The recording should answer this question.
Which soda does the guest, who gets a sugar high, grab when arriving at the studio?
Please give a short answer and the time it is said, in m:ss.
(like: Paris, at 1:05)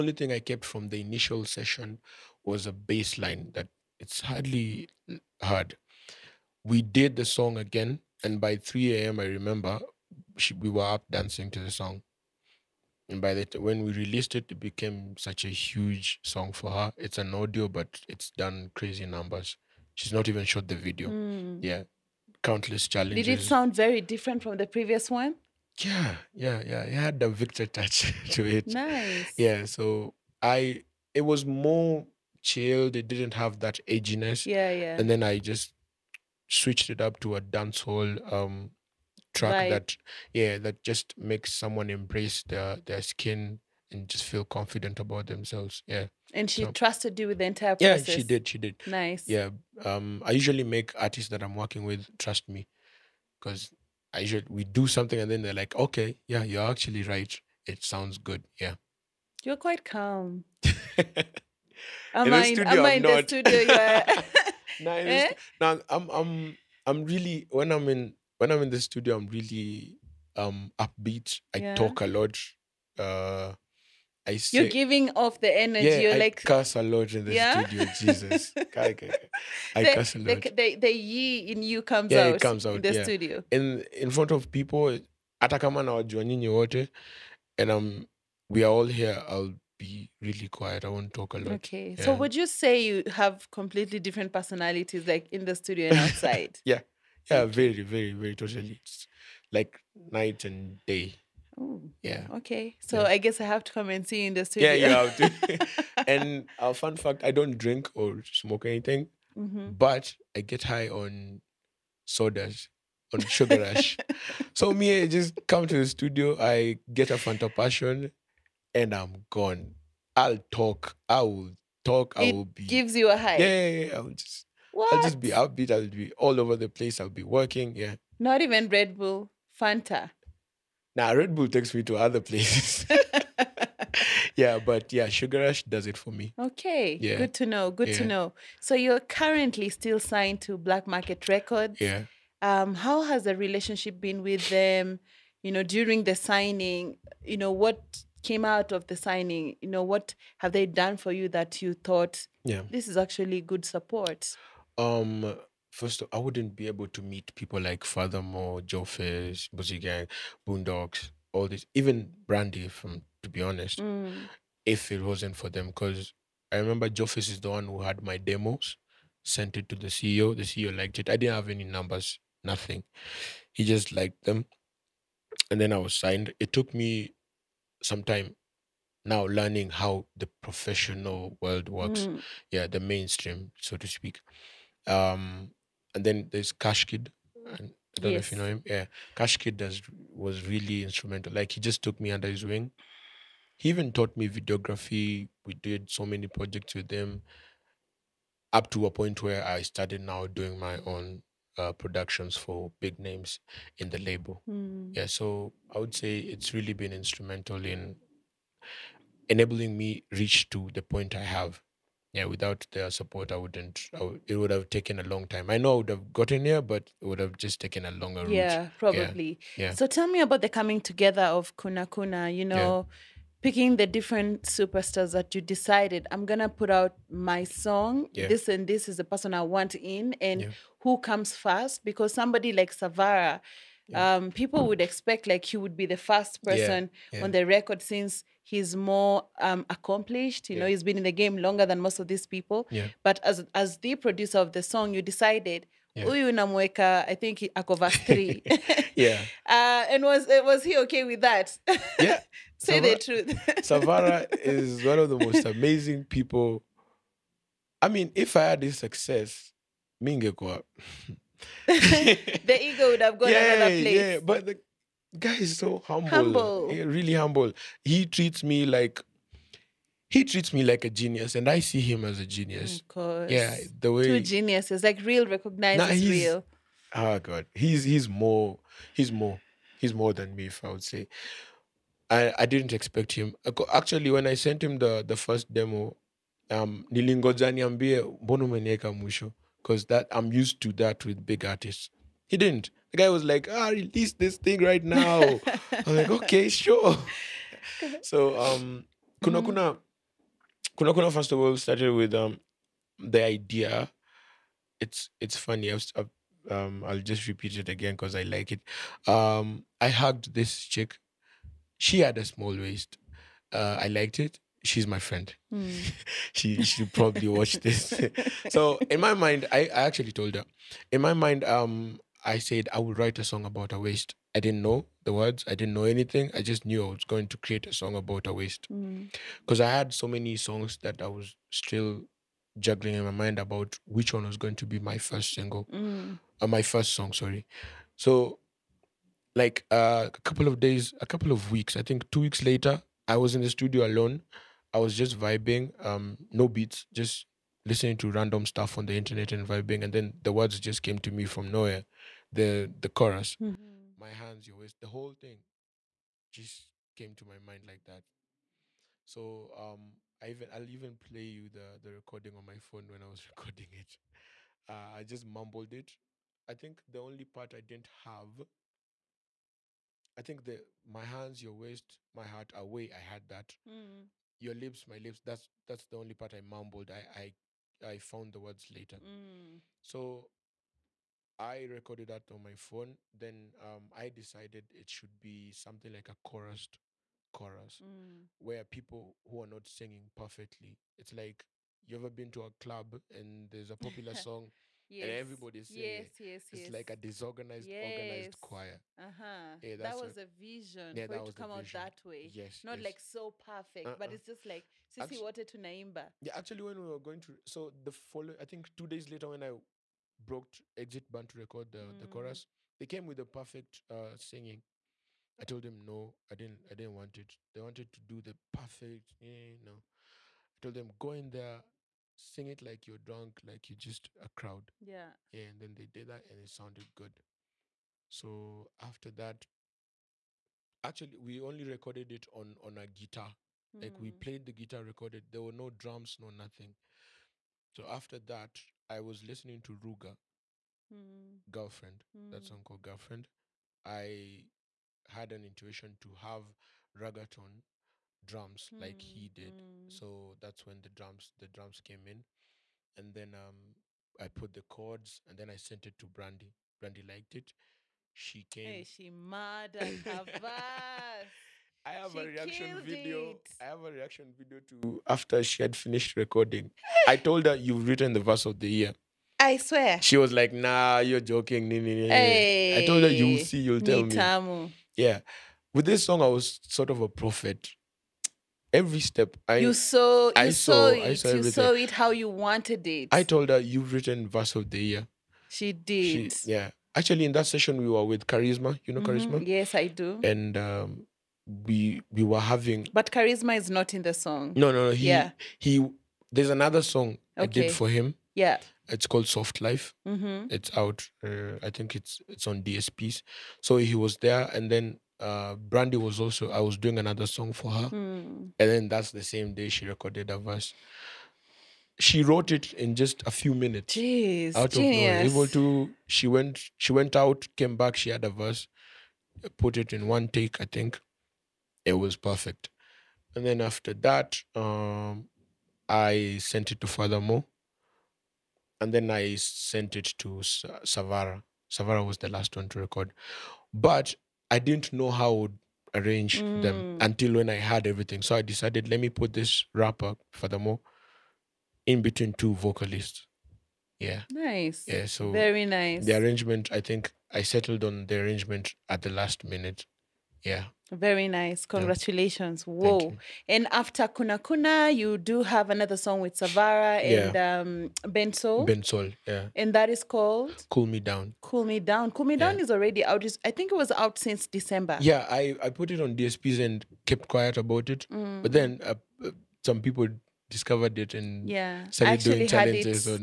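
Fanta Passion, at 1:57.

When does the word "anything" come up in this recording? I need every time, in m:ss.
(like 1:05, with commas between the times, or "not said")
1:48, 5:25.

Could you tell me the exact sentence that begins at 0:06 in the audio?
We did the song again, and by 3 a.m., I remember she, we were up dancing to the song.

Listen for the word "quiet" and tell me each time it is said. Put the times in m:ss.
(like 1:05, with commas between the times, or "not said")
1:30, 9:27.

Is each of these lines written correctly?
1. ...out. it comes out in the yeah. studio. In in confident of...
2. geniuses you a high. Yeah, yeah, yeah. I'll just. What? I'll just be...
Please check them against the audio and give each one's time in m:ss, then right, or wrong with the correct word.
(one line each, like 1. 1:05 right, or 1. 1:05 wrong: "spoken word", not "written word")
1. 1:22 wrong: "front", not "confident"
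2. 2:02 wrong: "gives", not "geniuses".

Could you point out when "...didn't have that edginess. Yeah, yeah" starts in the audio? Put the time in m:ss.
0:33.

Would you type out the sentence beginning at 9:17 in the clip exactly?
um Bensoul Bensoul yeah and that is called cool me down cool me down cool me yeah.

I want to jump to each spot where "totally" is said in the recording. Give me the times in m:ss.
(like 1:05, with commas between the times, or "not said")
1:38.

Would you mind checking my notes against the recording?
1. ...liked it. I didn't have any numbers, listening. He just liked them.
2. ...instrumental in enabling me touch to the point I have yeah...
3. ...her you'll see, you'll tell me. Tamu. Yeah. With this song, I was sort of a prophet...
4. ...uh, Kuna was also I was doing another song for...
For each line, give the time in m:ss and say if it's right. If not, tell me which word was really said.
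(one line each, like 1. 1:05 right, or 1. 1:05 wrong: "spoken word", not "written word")
1. 2:50 wrong: "nothing", not "listening"
2. 3:26 wrong: "reach", not "touch"
3. 7:53 right
4. 8:25 wrong: "Brandy", not "Kuna".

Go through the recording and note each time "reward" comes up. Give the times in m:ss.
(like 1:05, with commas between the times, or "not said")
not said.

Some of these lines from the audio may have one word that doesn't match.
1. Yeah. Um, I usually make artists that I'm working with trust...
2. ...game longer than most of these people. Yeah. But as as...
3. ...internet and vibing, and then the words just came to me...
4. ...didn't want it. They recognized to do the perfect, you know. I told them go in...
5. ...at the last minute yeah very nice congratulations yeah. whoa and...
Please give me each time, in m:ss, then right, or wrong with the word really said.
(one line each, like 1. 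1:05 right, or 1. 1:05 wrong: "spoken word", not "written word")
1. 0:49 right
2. 4:01 right
3. 5:48 right
4. 6:56 wrong: "wanted", not "recognized"
5. 9:08 right.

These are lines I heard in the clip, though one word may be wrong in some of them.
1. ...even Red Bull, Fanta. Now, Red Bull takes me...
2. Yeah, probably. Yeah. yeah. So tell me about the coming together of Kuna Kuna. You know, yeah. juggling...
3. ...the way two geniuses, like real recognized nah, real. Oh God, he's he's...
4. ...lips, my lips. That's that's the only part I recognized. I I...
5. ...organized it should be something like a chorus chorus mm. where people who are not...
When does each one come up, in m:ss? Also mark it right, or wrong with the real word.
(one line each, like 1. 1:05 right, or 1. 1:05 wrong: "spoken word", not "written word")
1. 2:08 right
2. 3:38 wrong: "picking", not "juggling"
3. 4:33 right
4. 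6:14 wrong: "mumbled", not "recognized"
5. 6:24 wrong: "decided", not "organized".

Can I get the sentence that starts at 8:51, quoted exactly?
Savara was the last one to record, but I didn't know how I would arrange mm.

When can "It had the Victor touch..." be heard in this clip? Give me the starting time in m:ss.
0:26.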